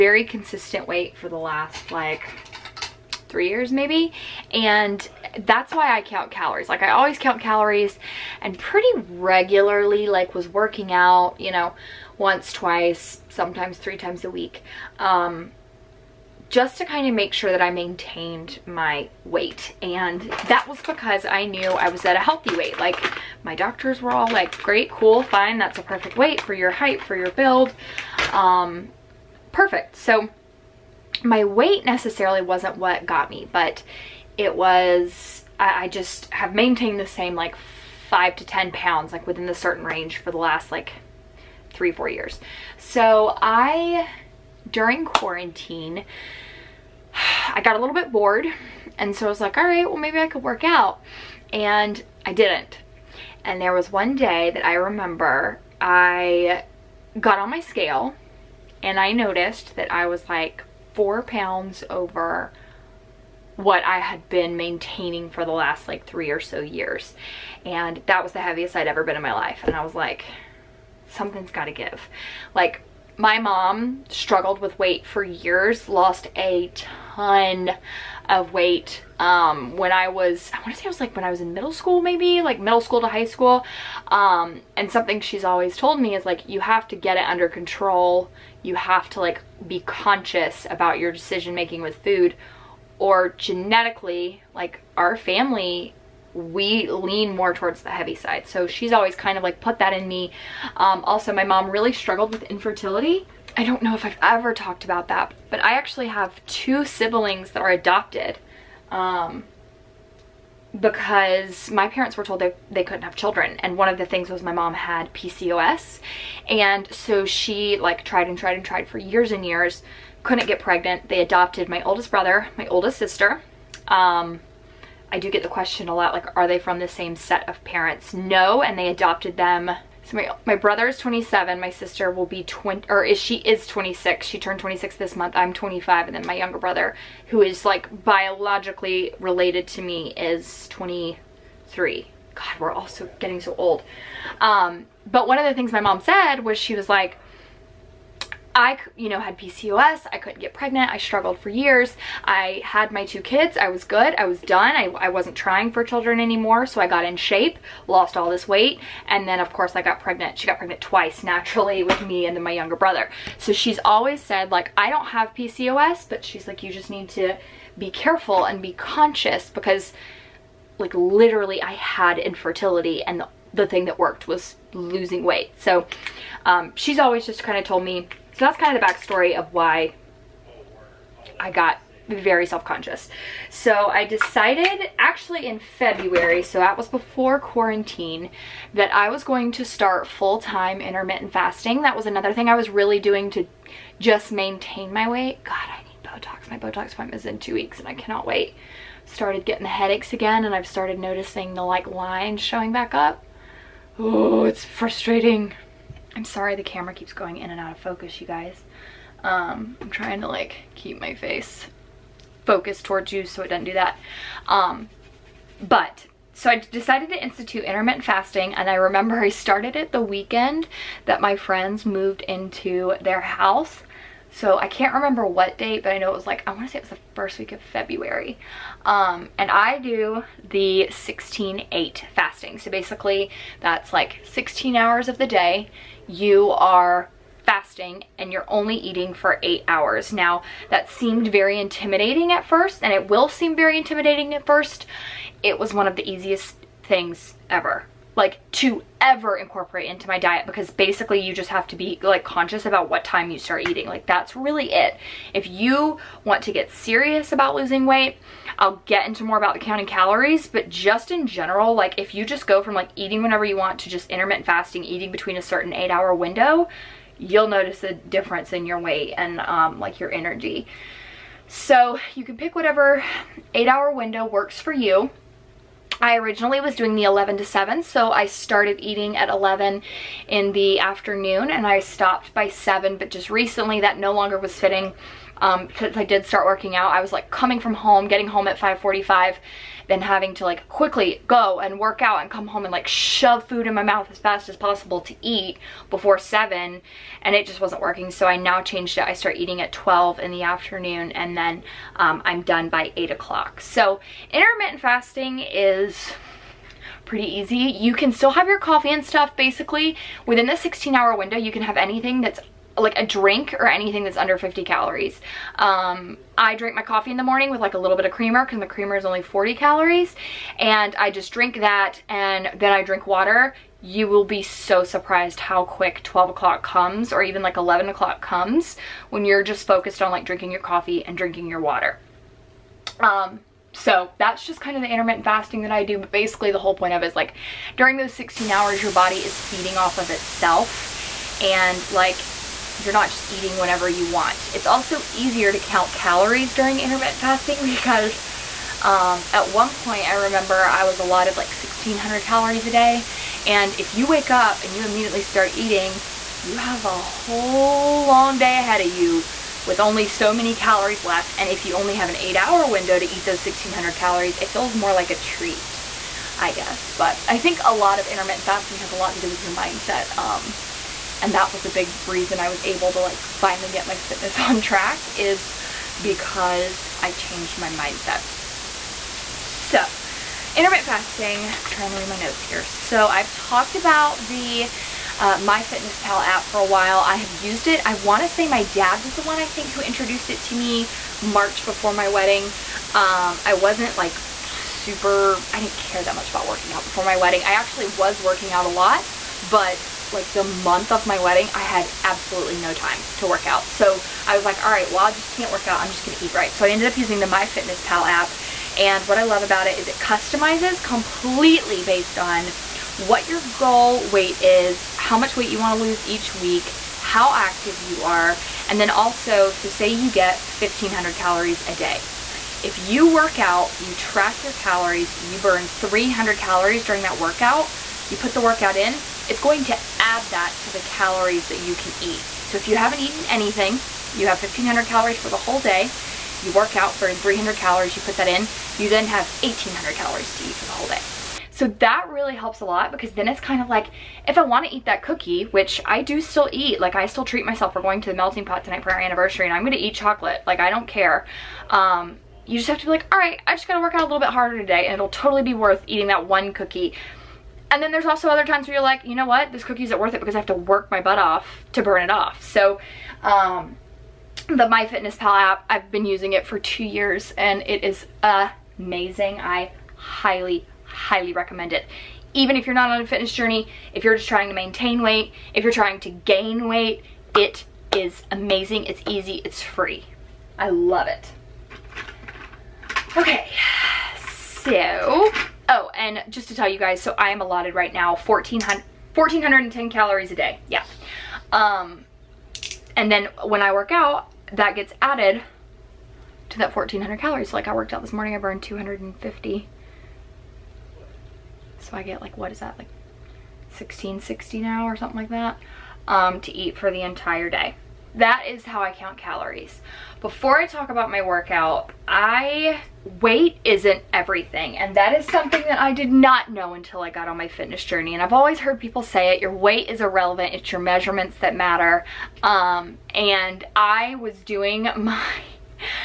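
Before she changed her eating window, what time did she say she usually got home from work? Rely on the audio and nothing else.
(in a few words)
5:45.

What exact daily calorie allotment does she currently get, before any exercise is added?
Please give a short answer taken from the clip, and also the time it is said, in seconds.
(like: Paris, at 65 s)
1410, at 489 s.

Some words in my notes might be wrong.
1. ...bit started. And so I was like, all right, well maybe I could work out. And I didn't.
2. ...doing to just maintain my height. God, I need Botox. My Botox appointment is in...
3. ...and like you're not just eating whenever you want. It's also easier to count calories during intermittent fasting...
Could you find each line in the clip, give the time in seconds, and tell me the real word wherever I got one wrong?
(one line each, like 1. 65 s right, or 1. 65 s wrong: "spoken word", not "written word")
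1. 47 s wrong: "bored", not "started"
2. 192 s wrong: "weight", not "height"
3. 341 s right.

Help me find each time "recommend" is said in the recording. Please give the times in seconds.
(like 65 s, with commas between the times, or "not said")
471 s.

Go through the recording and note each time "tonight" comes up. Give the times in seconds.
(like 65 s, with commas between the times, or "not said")
448 s.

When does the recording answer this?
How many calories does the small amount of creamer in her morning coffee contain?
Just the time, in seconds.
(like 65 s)
319 s.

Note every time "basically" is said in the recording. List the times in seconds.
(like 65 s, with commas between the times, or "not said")
232 s, 250 s, 309 s, 336 s.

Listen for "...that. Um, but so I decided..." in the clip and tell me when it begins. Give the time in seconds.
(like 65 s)
213 s.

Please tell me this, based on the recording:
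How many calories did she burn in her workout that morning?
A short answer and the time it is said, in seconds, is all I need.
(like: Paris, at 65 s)
250, at 498 s.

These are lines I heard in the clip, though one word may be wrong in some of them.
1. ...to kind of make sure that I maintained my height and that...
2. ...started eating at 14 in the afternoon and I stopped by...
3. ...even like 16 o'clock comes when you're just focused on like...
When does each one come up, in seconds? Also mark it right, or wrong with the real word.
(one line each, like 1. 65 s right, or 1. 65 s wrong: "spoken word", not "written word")
1. 16 s wrong: "weight", not "height"
2. 278 s wrong: "11", not "14"
3. 327 s wrong: "11", not "16".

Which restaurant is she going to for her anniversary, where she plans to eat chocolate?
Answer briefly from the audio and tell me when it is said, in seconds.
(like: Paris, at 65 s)
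The Melting Pot, at 448 s.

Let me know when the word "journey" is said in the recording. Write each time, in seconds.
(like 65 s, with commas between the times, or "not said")
473 s, 517 s.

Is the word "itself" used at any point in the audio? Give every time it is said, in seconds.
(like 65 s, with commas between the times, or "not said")
340 s.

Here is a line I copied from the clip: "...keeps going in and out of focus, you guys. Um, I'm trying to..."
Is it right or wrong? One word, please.
right.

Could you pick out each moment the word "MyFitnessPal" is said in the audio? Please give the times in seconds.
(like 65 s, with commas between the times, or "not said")
385 s, 407 s, 464 s.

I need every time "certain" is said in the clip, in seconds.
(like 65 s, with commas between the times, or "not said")
39 s, 265 s.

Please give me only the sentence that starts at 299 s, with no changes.
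I start eating at 12 in the afternoon and then um, I'm done by 8 o'clock.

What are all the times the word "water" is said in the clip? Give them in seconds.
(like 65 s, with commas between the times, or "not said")
323 s, 331 s.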